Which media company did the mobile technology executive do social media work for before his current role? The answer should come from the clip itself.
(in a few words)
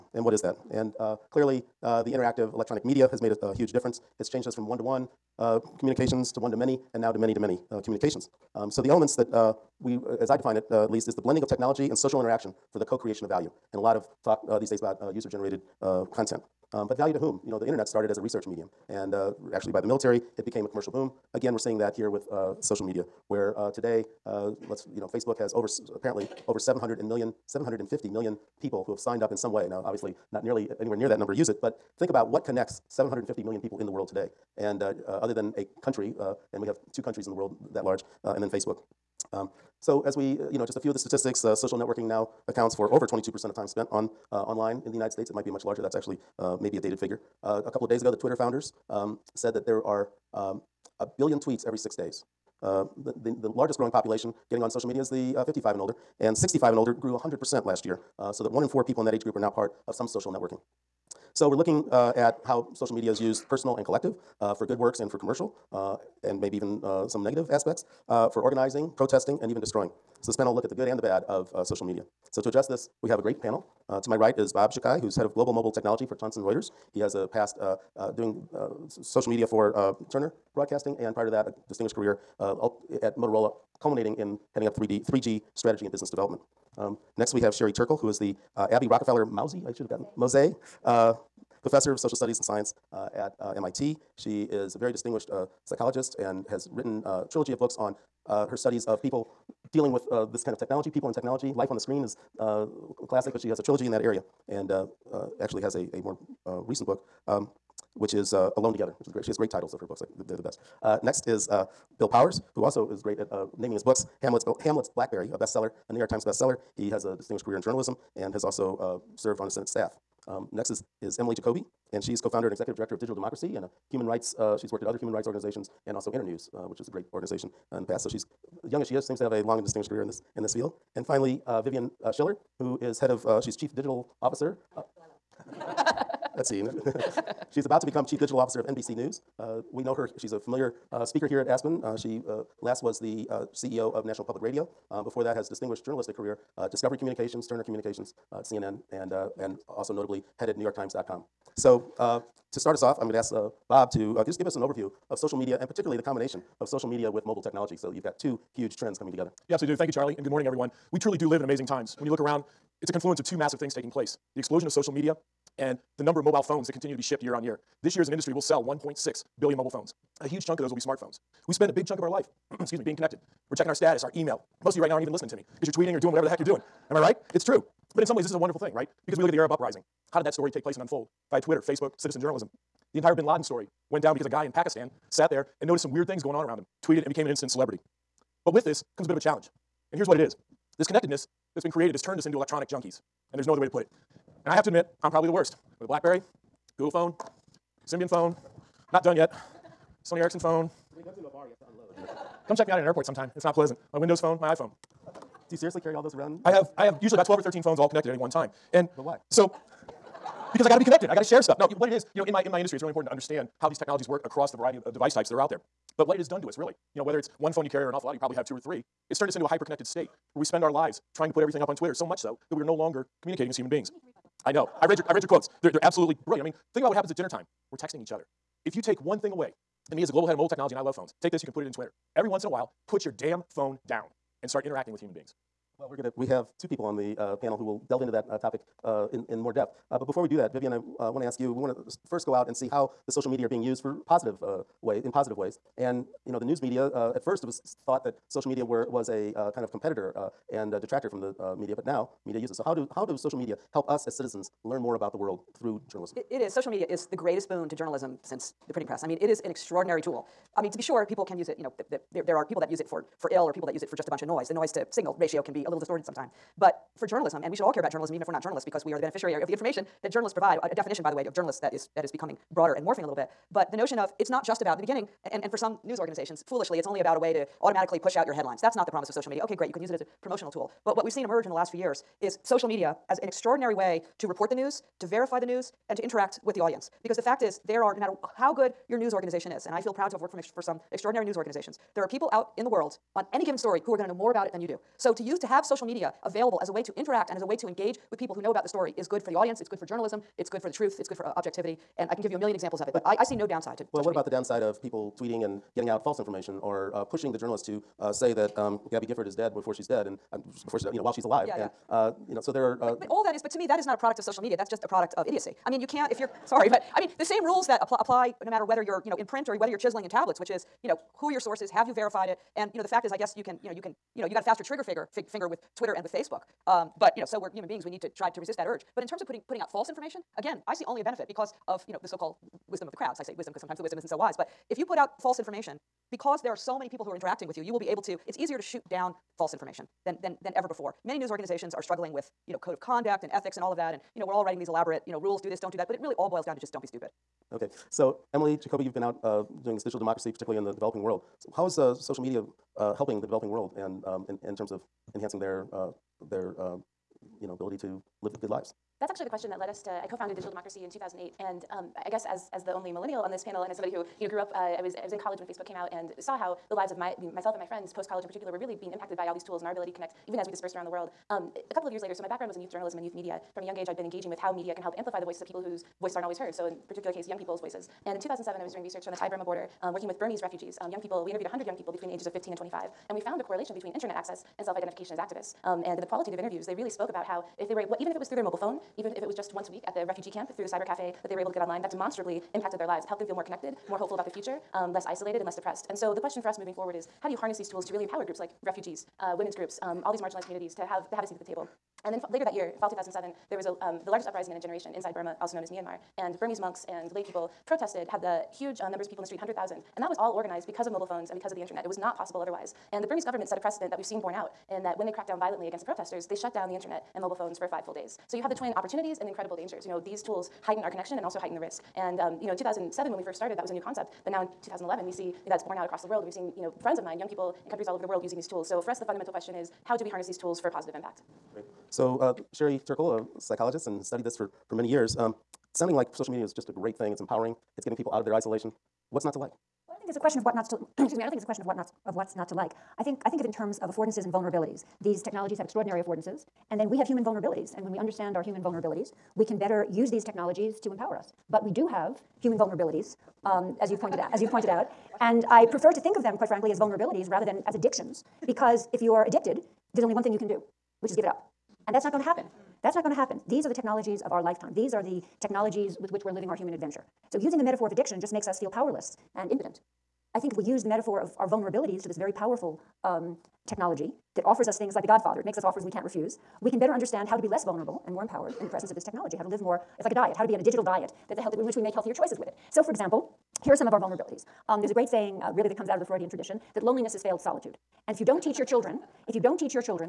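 Turner Broadcasting.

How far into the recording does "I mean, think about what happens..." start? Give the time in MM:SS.
03:46.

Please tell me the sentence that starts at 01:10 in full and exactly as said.
So this panel will look at the good and the bad of social media.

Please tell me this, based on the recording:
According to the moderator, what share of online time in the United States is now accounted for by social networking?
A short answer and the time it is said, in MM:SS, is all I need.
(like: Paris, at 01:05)
22%, at 00:43.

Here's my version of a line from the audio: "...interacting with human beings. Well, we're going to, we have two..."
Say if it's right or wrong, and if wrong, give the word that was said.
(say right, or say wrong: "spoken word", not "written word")
right.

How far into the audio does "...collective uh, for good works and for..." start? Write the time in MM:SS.
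01:03.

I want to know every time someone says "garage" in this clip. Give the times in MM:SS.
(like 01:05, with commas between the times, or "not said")
not said.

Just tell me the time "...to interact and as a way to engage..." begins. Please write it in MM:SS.
04:56.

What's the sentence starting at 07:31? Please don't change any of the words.
But we do have human vulnerabilities, um, as you've pointed out.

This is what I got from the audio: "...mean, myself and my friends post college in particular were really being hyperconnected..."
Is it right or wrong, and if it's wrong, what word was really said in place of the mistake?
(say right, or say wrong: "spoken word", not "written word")
wrong: "impacted", not "hyperconnected".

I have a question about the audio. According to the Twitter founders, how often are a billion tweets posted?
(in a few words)
every six days.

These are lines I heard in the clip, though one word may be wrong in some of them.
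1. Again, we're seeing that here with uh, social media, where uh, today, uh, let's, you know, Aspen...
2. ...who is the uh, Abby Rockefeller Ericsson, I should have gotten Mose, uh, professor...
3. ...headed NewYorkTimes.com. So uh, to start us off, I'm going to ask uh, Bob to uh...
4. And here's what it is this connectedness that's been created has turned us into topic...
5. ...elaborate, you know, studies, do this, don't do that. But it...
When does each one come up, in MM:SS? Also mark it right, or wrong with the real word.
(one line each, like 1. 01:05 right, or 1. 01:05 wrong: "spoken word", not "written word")
1. 00:21 wrong: "Facebook", not "Aspen"
2. 01:27 wrong: "Mousy", not "Ericsson"
3. 02:30 right
4. 03:09 wrong: "electronic", not "topic"
5. 05:44 wrong: "rules", not "studies".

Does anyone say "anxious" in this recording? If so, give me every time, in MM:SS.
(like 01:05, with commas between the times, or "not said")
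not said.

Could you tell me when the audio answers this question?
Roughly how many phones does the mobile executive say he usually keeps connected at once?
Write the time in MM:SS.
03:27.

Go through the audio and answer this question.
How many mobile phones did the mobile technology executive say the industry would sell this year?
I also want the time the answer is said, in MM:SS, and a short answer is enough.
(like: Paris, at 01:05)
1.6 billion, at 02:48.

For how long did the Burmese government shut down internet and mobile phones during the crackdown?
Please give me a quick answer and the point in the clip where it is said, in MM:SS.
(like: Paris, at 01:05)
5 days, at 06:57.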